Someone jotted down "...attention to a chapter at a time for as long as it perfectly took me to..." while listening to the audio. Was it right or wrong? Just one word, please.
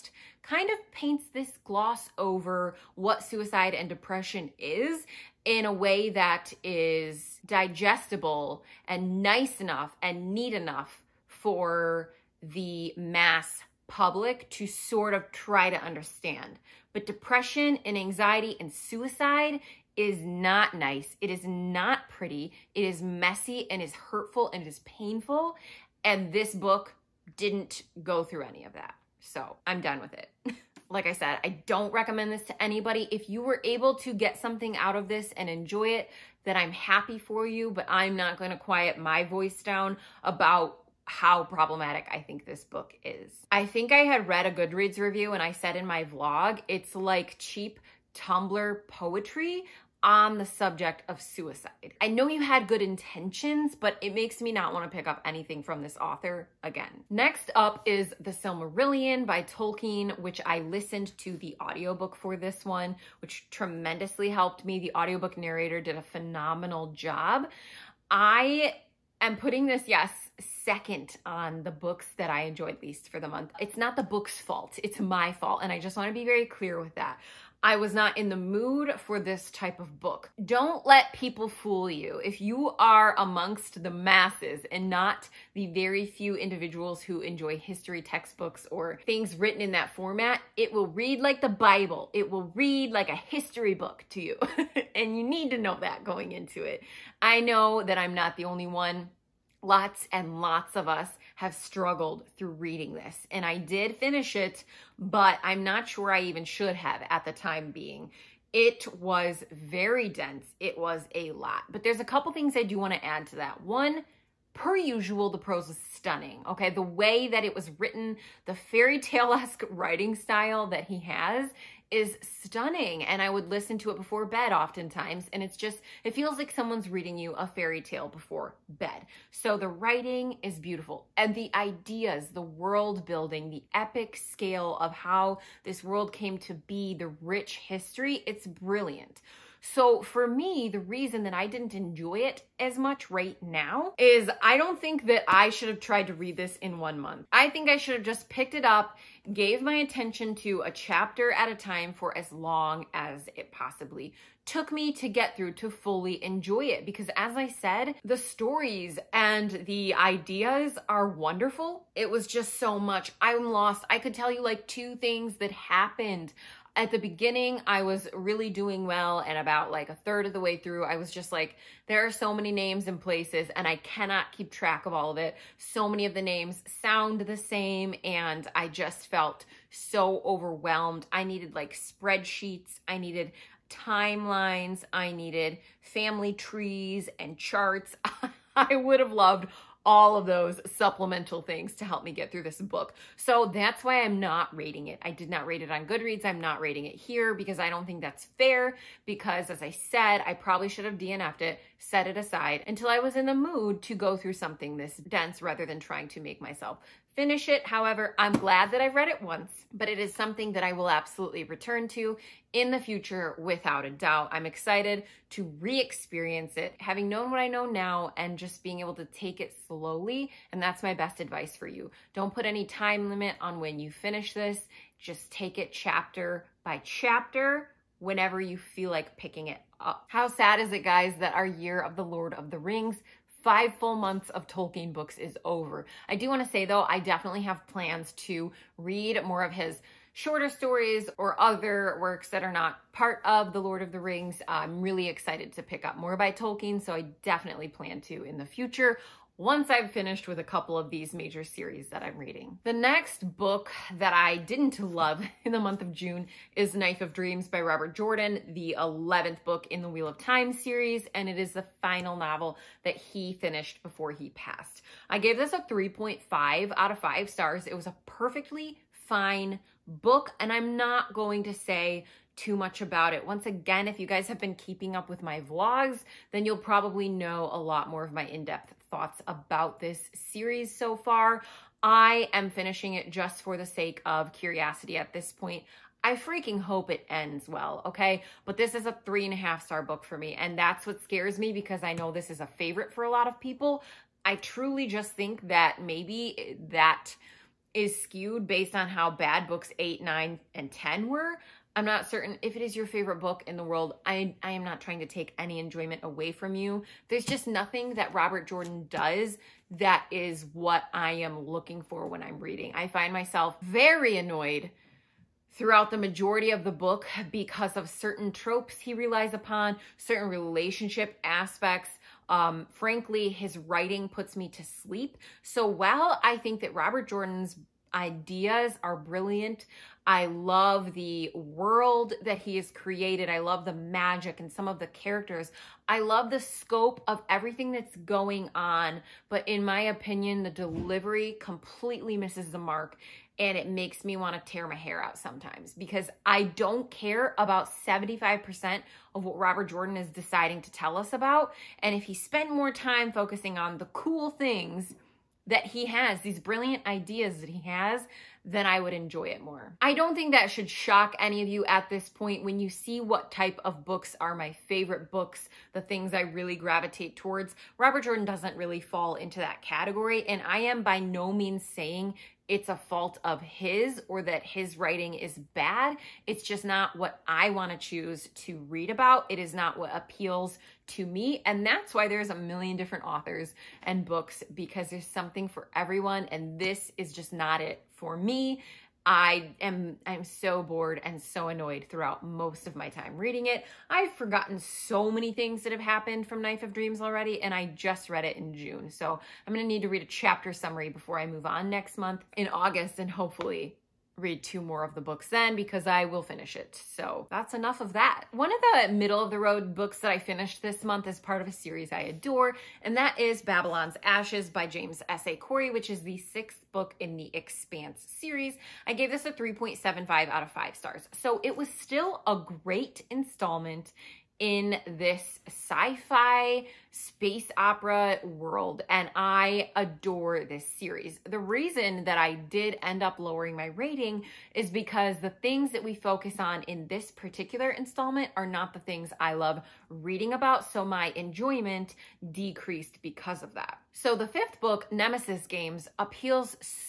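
wrong.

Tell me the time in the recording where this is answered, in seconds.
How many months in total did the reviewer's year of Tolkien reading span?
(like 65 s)
233 s.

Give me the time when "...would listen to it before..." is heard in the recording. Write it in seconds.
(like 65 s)
123 s.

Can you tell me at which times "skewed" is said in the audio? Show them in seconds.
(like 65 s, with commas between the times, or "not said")
298 s.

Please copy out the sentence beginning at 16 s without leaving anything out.
But depression and anxiety and suicide is not nice.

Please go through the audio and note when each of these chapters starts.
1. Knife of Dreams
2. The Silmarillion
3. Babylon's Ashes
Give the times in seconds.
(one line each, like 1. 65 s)
1. 252 s
2. 56 s
3. 407 s.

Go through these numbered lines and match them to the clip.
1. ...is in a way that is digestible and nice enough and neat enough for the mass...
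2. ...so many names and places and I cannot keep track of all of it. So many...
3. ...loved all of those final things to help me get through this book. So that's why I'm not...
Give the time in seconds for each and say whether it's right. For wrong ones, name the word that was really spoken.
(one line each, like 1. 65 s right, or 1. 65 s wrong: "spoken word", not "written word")
1. 4 s right
2. 172 s right
3. 189 s wrong: "supplemental", not "final".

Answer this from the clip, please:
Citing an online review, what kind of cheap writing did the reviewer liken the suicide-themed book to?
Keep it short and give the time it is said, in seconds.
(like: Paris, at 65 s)
Tumblr poetry, at 48 s.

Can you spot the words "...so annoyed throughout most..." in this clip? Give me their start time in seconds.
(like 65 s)
391 s.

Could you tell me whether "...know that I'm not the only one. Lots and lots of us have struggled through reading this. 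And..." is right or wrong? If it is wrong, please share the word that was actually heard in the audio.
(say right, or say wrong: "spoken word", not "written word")
right.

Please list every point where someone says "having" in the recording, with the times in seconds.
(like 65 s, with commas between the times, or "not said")
216 s.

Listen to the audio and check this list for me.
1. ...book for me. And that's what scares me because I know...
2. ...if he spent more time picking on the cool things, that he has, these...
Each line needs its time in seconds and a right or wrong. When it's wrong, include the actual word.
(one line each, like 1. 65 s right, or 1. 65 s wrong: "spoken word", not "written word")
1. 289 s right
2. 351 s wrong: "focusing", not "picking".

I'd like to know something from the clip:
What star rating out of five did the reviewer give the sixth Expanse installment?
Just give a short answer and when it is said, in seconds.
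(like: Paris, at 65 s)
3.75, at 419 s.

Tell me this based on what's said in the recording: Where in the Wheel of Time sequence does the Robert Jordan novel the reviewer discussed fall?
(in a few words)
11th.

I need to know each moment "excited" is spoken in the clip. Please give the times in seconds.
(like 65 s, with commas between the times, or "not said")
214 s, 245 s.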